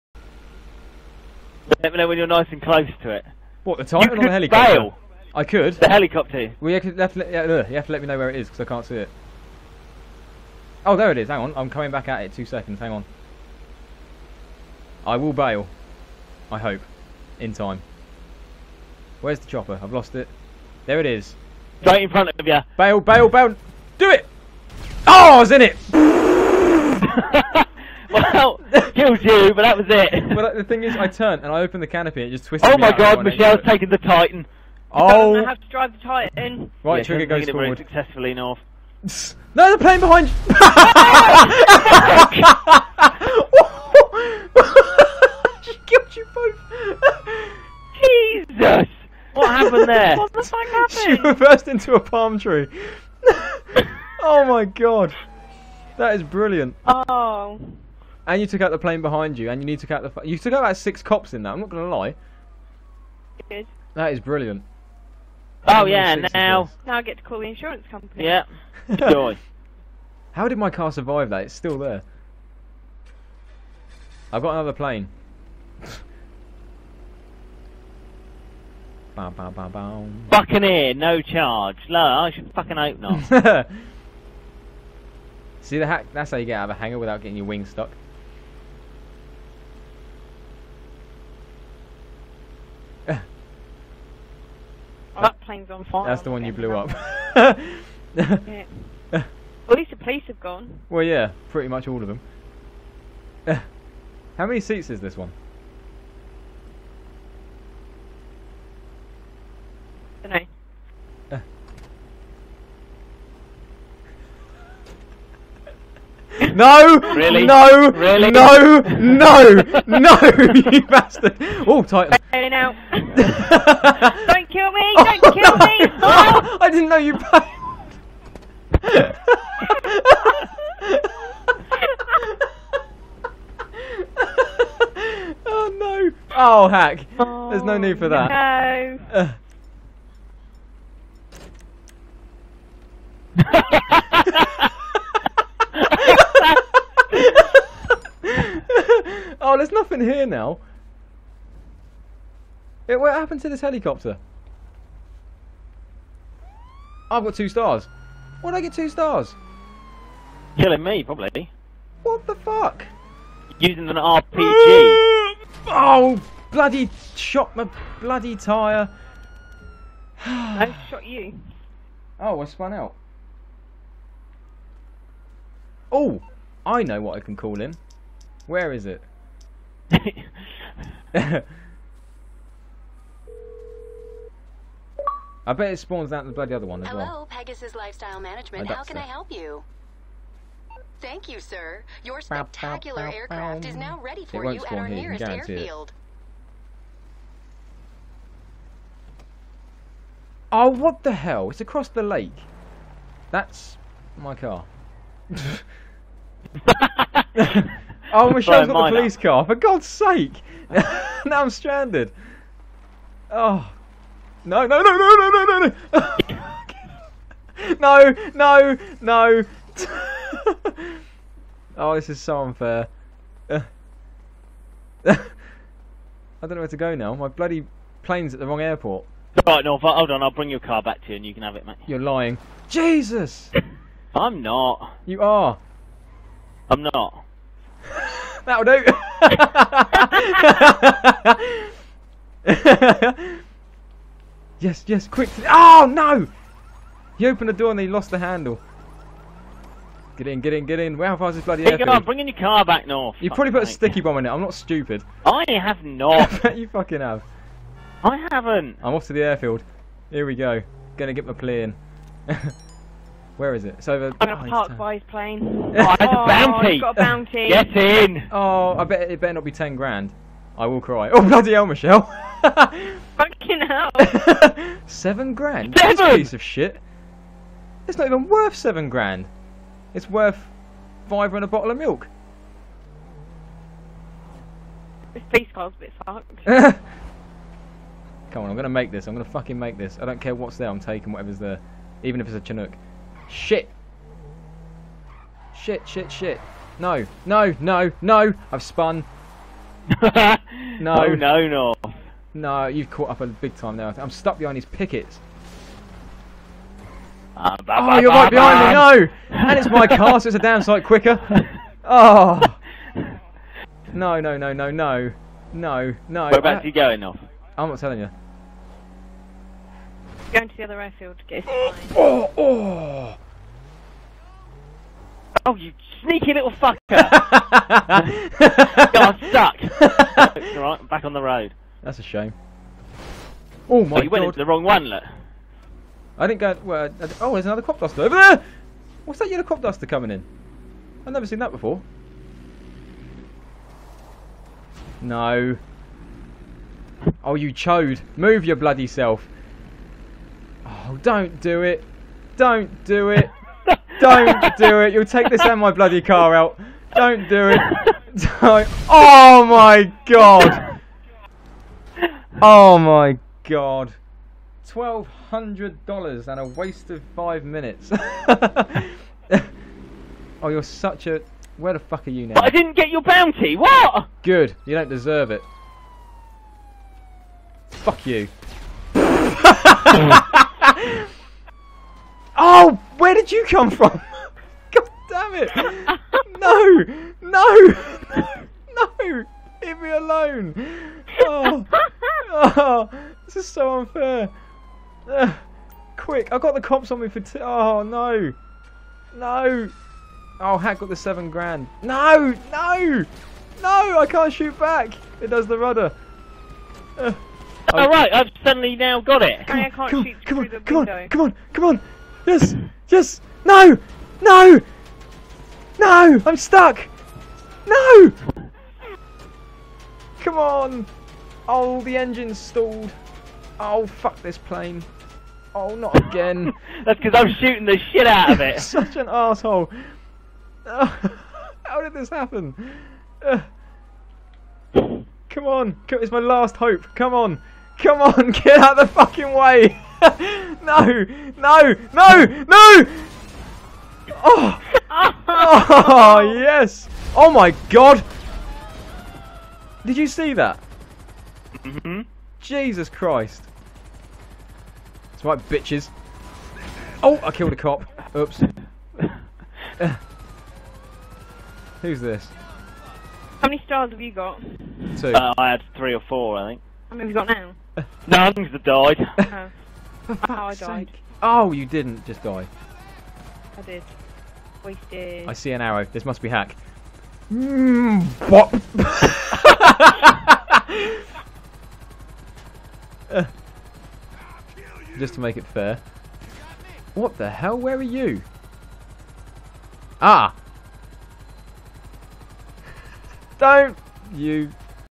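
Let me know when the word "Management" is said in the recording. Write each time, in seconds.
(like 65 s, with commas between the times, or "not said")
188 s.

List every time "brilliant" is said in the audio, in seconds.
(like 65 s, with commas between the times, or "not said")
56 s, 64 s.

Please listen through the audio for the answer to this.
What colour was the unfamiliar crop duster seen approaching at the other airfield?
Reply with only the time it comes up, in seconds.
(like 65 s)
339 s.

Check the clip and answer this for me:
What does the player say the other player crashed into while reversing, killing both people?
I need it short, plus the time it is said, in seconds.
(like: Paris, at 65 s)
A palm tree, at 51 s.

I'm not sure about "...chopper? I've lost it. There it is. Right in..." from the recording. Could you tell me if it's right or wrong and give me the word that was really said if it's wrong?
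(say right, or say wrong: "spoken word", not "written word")
right.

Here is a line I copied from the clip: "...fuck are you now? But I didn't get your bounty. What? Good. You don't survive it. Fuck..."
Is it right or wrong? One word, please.
wrong.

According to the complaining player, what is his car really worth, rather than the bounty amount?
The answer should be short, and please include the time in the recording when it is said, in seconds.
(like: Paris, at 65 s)
5 and a bottle of milk, at 281 s.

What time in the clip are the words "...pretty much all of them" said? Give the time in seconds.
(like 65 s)
101 s.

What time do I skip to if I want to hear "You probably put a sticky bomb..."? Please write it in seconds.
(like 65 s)
253 s.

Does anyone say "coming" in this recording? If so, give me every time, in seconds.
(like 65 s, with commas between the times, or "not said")
11 s, 339 s.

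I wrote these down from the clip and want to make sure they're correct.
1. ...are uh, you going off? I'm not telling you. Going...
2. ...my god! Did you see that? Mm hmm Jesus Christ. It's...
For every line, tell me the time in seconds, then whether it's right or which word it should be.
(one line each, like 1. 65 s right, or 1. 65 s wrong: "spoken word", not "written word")
1. 316 s right
2. 447 s right.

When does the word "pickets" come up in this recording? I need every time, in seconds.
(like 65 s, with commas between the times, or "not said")
304 s.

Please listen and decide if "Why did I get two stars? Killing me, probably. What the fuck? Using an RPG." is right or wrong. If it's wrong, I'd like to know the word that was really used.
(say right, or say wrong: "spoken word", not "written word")
right.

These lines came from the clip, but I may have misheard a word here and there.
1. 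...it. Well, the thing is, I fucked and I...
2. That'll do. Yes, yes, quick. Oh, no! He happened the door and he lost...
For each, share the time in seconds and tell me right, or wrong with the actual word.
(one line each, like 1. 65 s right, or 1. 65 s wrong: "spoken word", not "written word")
1. 29 s wrong: "turned", not "fucked"
2. 238 s wrong: "opened", not "happened".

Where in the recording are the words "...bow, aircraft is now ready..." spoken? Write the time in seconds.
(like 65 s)
193 s.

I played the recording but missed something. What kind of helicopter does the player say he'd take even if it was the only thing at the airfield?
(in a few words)
Chinook.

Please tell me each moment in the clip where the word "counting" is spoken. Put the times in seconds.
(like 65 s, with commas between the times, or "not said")
not said.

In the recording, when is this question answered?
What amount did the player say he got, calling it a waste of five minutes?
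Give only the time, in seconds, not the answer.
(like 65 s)
364 s.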